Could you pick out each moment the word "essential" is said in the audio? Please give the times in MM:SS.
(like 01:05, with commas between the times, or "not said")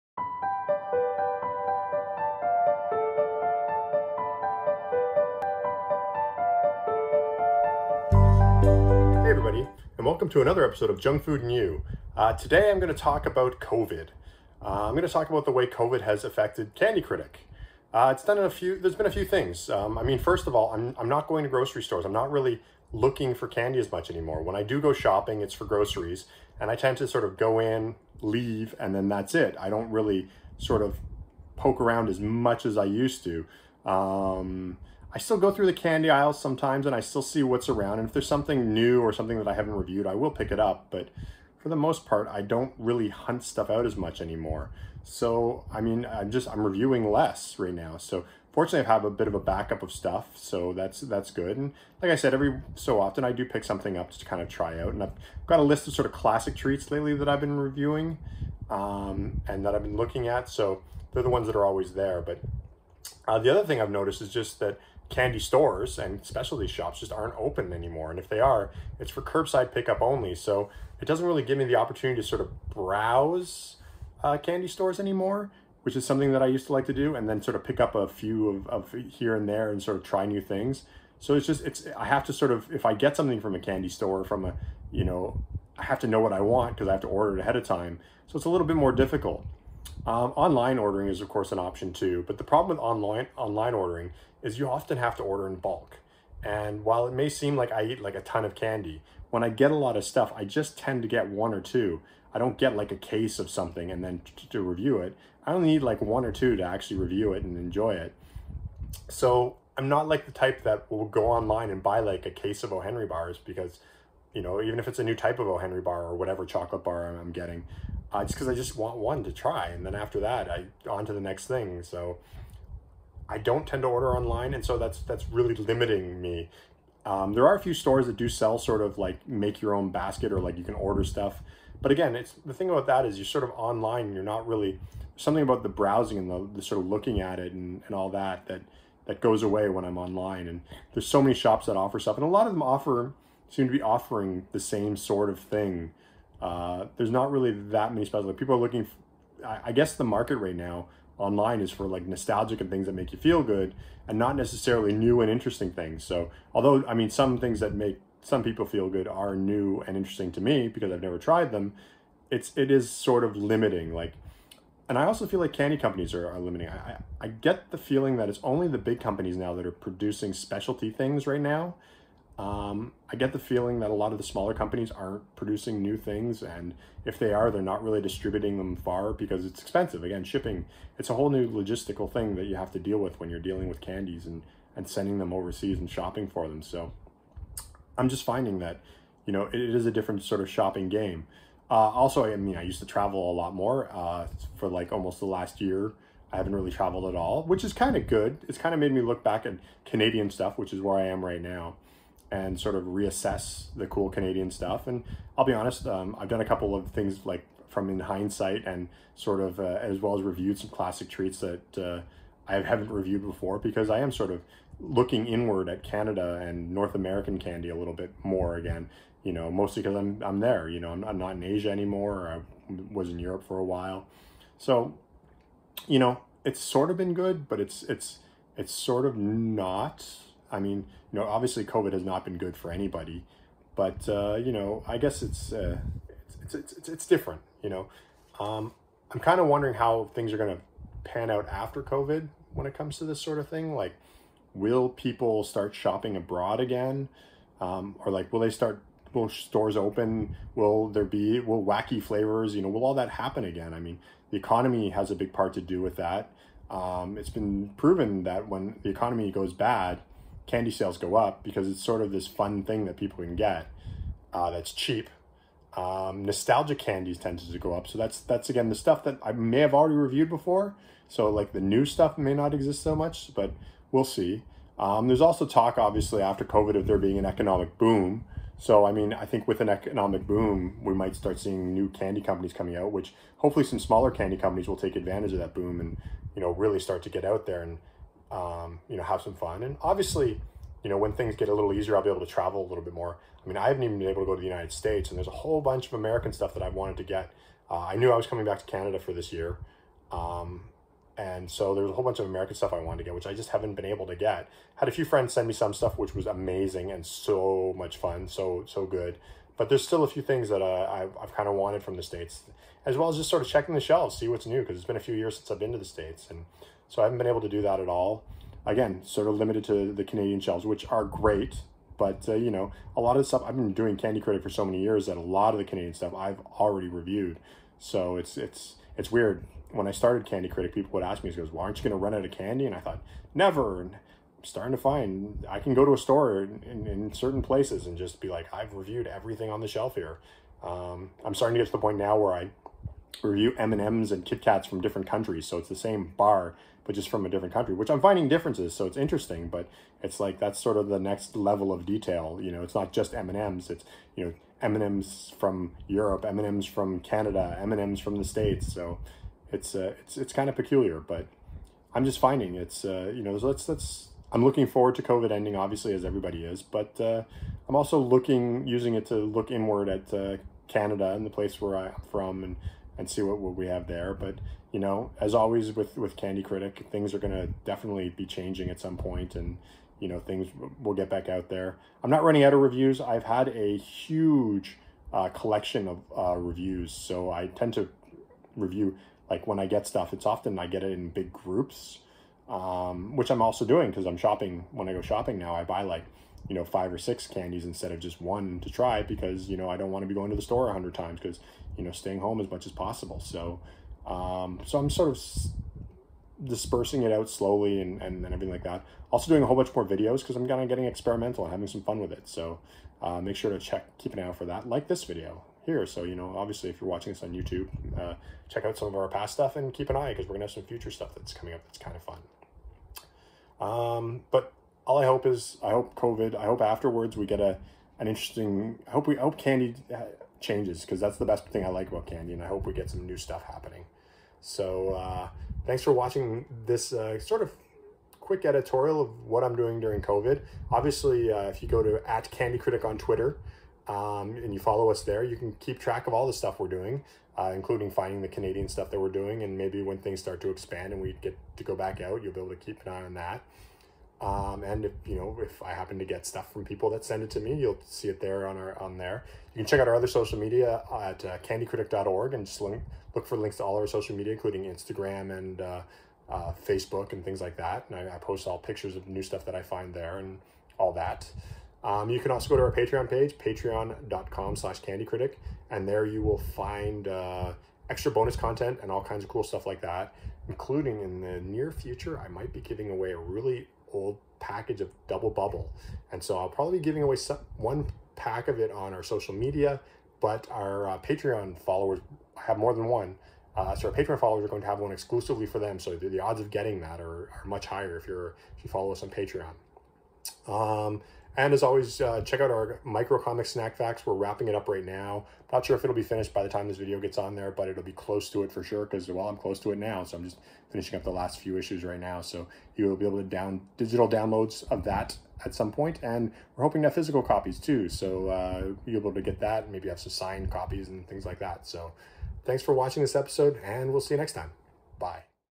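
not said.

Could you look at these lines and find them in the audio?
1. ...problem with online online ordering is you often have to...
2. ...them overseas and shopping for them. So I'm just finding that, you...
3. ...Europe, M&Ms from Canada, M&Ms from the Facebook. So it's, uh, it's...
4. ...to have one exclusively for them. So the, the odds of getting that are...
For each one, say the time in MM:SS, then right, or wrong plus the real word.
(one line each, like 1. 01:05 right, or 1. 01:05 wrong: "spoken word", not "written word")
1. 01:32 right
2. 03:05 right
3. 05:55 wrong: "States", not "Facebook"
4. 08:14 right.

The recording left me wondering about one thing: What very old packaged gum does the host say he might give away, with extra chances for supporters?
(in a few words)
Double Bubble.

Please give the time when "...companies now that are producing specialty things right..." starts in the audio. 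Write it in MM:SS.
02:48.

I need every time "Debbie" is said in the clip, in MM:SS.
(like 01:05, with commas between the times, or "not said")
not said.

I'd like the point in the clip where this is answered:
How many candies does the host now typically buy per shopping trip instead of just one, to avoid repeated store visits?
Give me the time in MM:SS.
06:36.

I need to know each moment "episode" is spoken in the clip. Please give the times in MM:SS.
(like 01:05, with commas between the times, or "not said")
00:10, 08:43.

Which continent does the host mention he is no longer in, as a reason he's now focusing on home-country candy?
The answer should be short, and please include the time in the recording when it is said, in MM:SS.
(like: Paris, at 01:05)
Asia, at 03:41.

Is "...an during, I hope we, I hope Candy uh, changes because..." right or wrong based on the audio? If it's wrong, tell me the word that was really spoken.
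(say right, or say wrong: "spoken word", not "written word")
wrong: "interesting", not "during".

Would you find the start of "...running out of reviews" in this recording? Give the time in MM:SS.
06:22.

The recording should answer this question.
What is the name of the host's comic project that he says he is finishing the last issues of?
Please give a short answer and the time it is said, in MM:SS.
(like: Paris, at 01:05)
Snack Facts, at 08:23.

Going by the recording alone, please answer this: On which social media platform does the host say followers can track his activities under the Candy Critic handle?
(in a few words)
Twitter.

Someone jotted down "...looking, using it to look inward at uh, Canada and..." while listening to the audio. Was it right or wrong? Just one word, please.
right.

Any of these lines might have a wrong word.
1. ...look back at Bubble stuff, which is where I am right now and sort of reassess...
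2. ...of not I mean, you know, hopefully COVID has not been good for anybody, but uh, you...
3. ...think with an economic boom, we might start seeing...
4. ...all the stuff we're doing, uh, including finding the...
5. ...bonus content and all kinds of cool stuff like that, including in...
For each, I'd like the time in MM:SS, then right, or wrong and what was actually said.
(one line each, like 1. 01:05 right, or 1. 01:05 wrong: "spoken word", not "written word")
1. 03:19 wrong: "Canadian", not "Bubble"
2. 03:49 wrong: "obviously", not "hopefully"
3. 04:39 right
4. 07:26 right
5. 07:58 right.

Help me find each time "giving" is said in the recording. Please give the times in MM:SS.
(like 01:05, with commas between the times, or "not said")
08:02, 08:06.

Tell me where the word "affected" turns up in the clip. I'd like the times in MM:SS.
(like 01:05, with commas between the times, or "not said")
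00:16.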